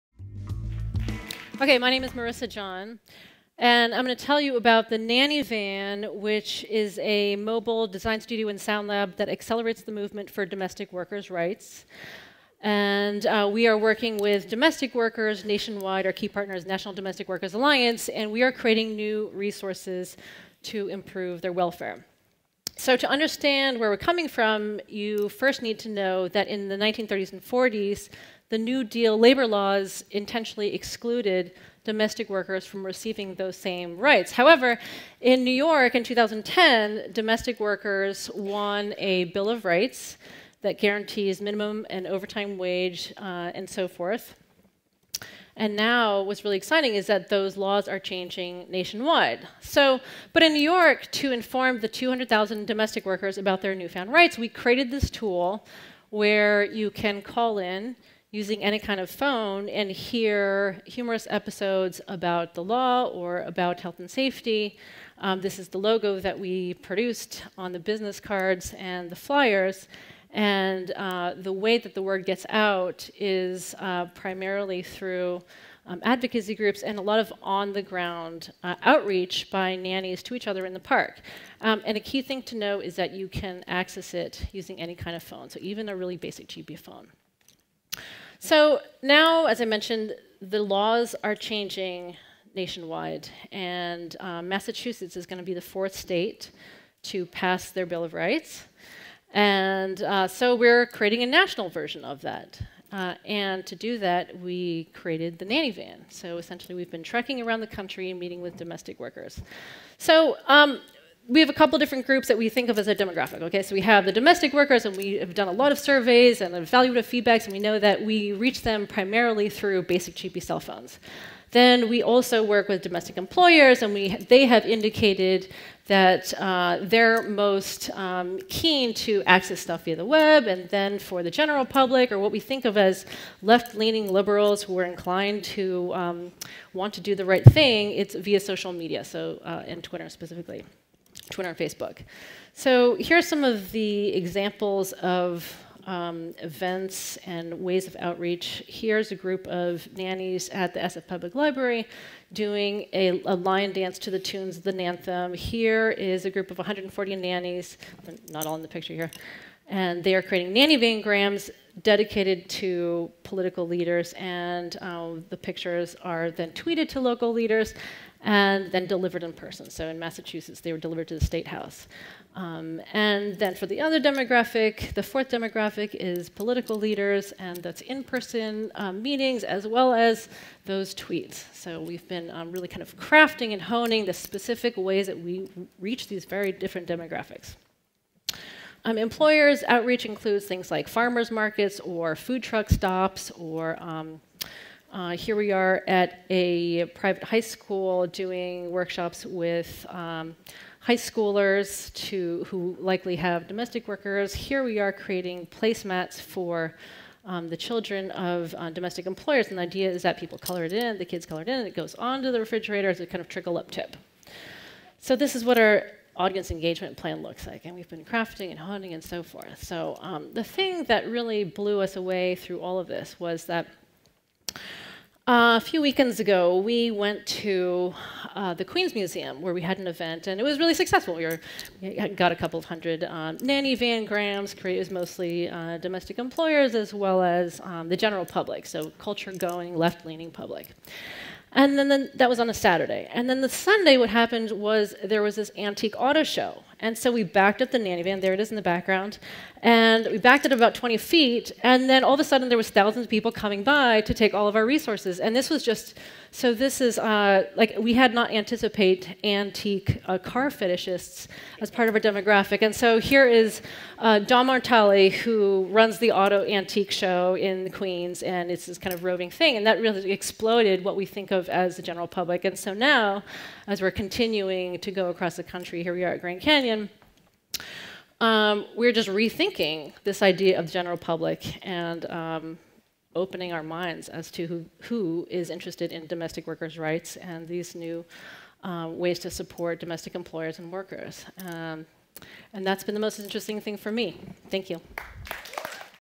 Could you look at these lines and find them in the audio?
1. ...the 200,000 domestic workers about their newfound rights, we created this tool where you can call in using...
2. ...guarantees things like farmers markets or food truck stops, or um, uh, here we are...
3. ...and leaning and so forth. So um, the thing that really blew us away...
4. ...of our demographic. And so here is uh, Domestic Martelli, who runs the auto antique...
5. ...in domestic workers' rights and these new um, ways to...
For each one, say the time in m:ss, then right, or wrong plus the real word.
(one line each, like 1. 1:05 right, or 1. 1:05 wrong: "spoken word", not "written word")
1. 0:51 right
2. 3:10 wrong: "includes", not "guarantees"
3. 3:38 wrong: "honing", not "leaning"
4. 4:21 wrong: "Don", not "Domestic"
5. 4:45 right.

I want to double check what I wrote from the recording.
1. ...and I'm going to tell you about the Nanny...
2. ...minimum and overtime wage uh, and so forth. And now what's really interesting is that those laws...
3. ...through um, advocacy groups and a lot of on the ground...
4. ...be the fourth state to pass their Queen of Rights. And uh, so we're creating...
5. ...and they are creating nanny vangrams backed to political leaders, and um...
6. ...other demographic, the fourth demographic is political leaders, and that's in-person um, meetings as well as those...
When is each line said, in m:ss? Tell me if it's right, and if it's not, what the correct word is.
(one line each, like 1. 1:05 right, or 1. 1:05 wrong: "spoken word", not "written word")
1. 0:03 right
2. 0:41 wrong: "exciting", not "interesting"
3. 1:14 right
4. 1:35 wrong: "Bill", not "Queen"
5. 2:39 wrong: "dedicated", not "backed"
6. 2:53 right.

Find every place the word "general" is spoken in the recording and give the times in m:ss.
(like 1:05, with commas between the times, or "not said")
2:11, 3:57, 4:31, 4:40.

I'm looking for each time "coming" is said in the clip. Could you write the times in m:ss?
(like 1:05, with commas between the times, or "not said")
0:24, 4:13.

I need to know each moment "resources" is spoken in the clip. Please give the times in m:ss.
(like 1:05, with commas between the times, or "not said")
0:19, 4:14.